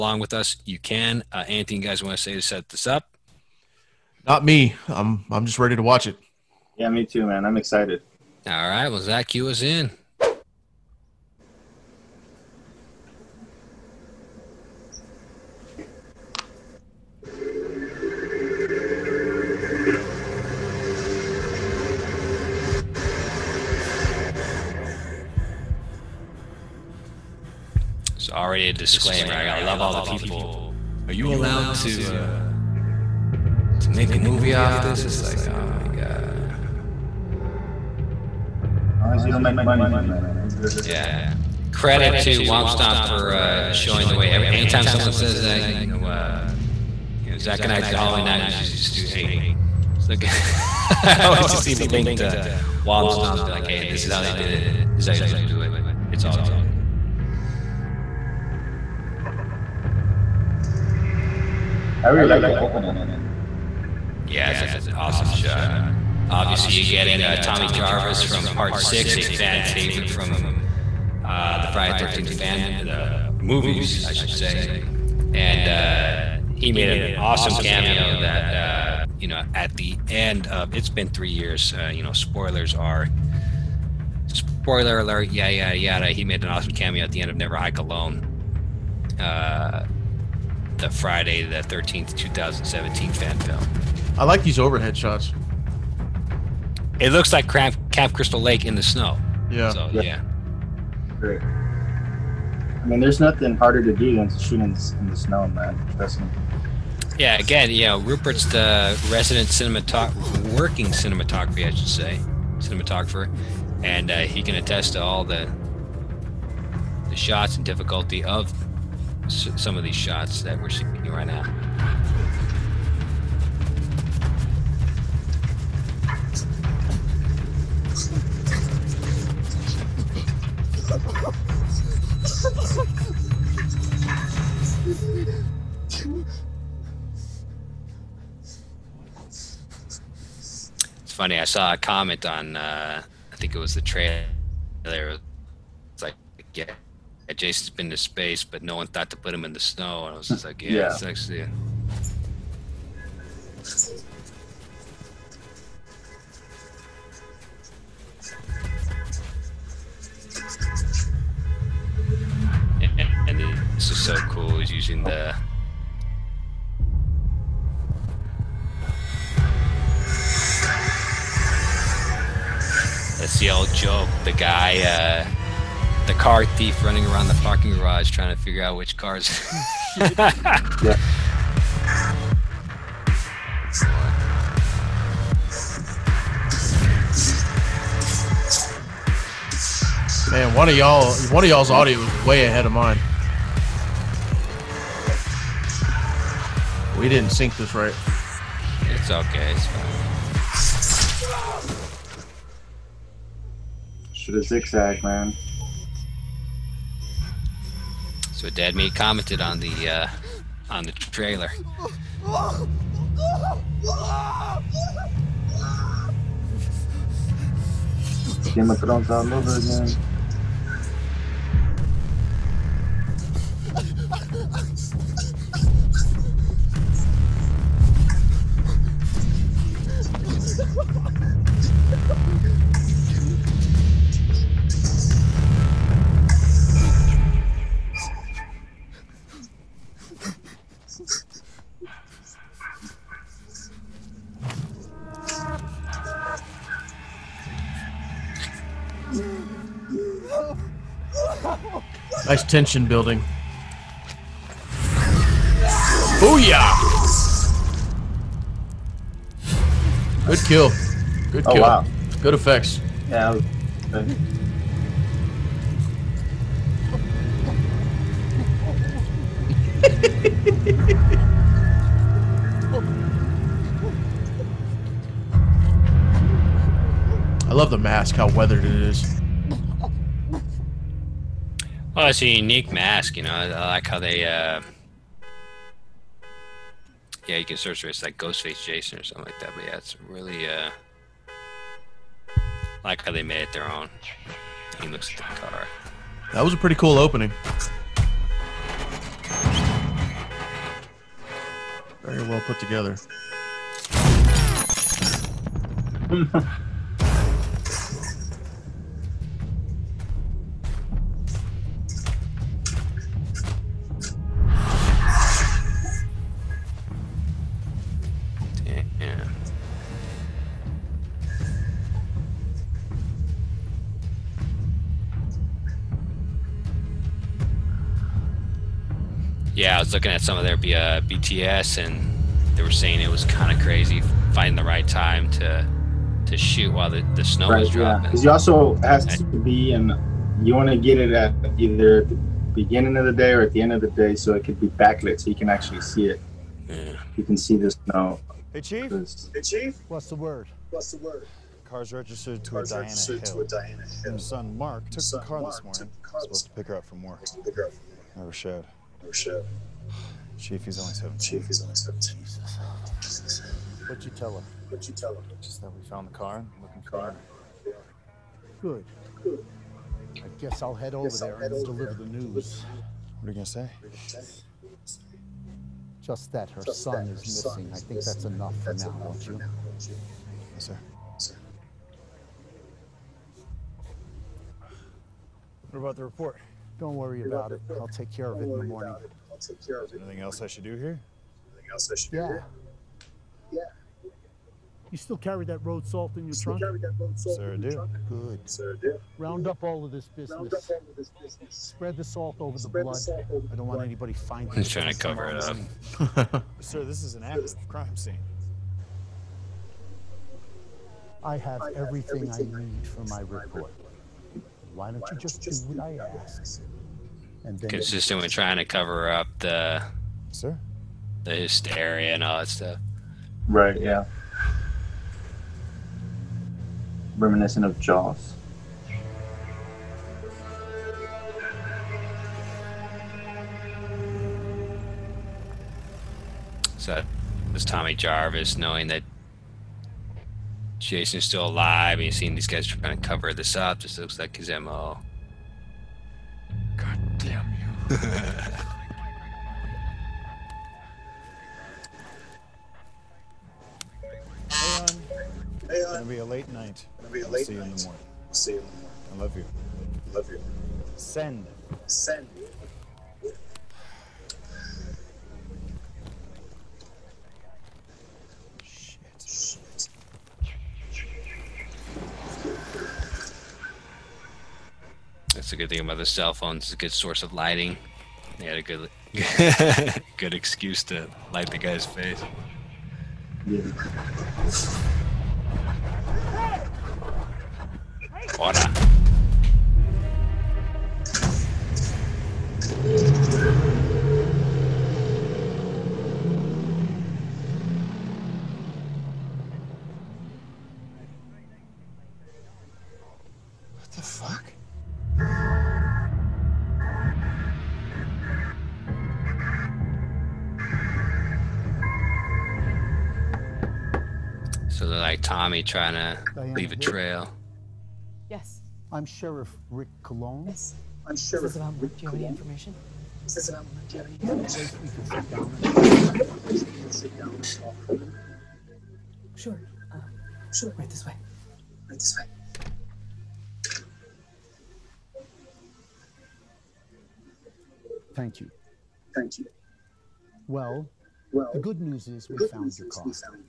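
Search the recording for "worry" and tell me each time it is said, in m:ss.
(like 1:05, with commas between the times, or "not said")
6:26.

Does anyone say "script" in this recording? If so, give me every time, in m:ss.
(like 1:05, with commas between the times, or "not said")
not said.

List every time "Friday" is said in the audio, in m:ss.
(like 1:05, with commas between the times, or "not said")
1:11, 1:30.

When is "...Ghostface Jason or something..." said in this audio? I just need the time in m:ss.
4:48.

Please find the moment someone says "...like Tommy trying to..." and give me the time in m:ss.
8:35.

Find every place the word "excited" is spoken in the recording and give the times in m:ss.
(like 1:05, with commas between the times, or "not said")
0:07.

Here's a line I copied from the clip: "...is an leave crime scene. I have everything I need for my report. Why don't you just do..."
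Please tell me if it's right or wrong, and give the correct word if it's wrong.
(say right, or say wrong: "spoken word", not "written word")
wrong: "active", not "leave".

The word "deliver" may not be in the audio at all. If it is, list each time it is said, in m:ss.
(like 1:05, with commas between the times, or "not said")
6:11.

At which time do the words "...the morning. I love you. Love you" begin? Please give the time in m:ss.
7:38.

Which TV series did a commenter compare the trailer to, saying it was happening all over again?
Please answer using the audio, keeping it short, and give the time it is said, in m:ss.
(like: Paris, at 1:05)
Game of Thrones, at 3:38.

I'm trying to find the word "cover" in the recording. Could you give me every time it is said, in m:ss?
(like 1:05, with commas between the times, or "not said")
6:44, 6:58, 7:23.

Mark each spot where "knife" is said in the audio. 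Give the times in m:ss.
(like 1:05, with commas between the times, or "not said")
not said.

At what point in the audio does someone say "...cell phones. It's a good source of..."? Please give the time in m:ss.
7:56.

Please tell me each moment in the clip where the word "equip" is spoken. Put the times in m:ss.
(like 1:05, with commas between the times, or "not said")
not said.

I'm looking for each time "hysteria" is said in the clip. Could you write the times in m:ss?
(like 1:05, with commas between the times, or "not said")
7:01.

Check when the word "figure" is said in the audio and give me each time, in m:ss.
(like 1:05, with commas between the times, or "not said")
2:58.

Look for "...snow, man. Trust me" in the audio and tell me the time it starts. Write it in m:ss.
1:45.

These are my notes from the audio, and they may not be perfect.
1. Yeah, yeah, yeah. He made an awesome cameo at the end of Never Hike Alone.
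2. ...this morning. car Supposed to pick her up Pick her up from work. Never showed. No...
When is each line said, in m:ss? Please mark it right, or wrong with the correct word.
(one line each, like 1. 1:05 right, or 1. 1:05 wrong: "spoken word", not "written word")
1. 1:25 right
2. 5:55 right.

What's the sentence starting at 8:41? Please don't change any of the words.
I'm Sheriff this Do you have any information.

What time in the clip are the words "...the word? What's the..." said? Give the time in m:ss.
5:50.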